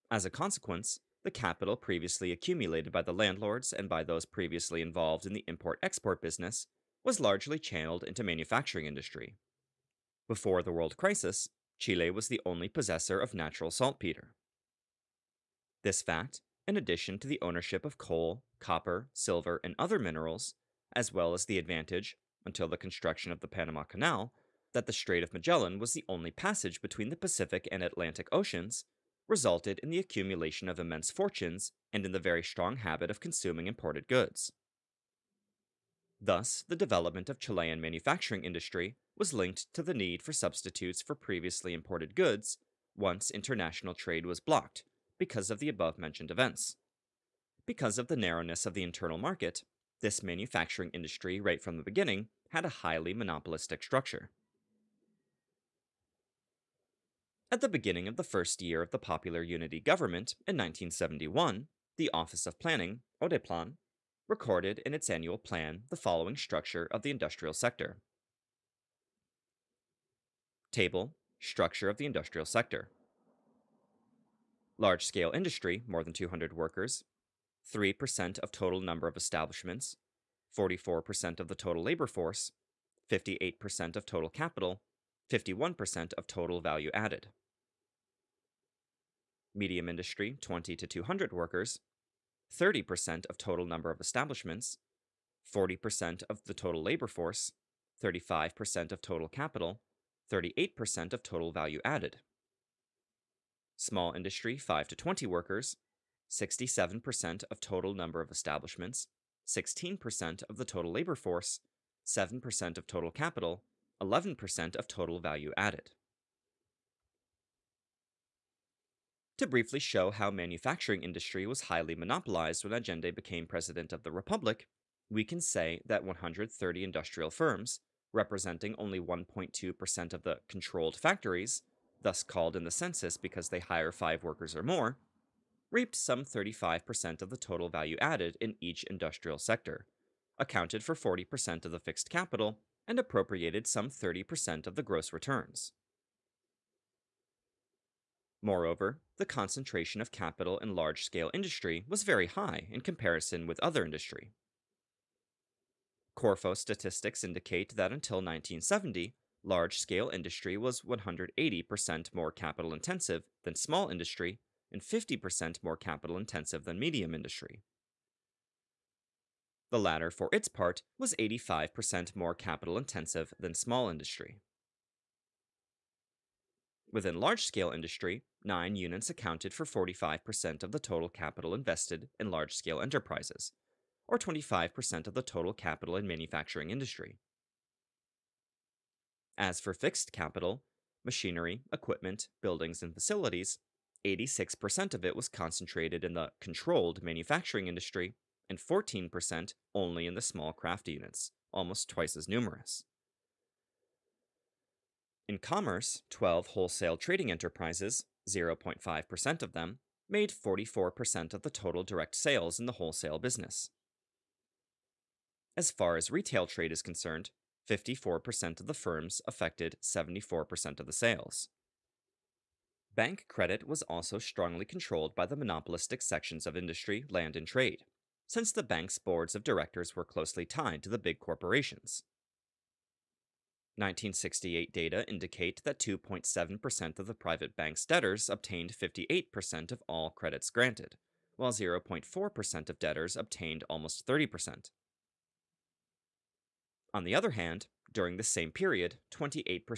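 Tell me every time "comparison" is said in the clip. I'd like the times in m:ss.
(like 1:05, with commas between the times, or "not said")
2:32.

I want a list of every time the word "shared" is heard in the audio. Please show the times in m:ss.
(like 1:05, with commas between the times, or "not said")
not said.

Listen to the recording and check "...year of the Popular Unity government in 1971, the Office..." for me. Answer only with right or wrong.
right.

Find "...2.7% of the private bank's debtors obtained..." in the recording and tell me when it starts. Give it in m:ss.
3:55.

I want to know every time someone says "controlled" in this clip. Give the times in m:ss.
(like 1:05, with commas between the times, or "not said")
2:10, 3:16, 3:44.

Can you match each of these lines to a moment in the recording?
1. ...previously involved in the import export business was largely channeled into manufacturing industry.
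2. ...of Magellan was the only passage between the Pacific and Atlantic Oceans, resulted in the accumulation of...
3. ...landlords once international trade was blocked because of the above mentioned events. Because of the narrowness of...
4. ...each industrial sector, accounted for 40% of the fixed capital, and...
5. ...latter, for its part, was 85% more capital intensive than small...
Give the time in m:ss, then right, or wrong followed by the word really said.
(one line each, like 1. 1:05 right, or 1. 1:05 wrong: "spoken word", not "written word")
1. 0:04 right
2. 0:25 right
3. 0:42 wrong: "goods", not "landlords"
4. 2:18 right
5. 2:49 right.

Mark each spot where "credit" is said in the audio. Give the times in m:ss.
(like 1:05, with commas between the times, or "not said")
3:43, 4:00.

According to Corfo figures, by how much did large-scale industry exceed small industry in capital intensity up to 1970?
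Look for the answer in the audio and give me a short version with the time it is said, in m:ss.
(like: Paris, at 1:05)
180%, at 2:40.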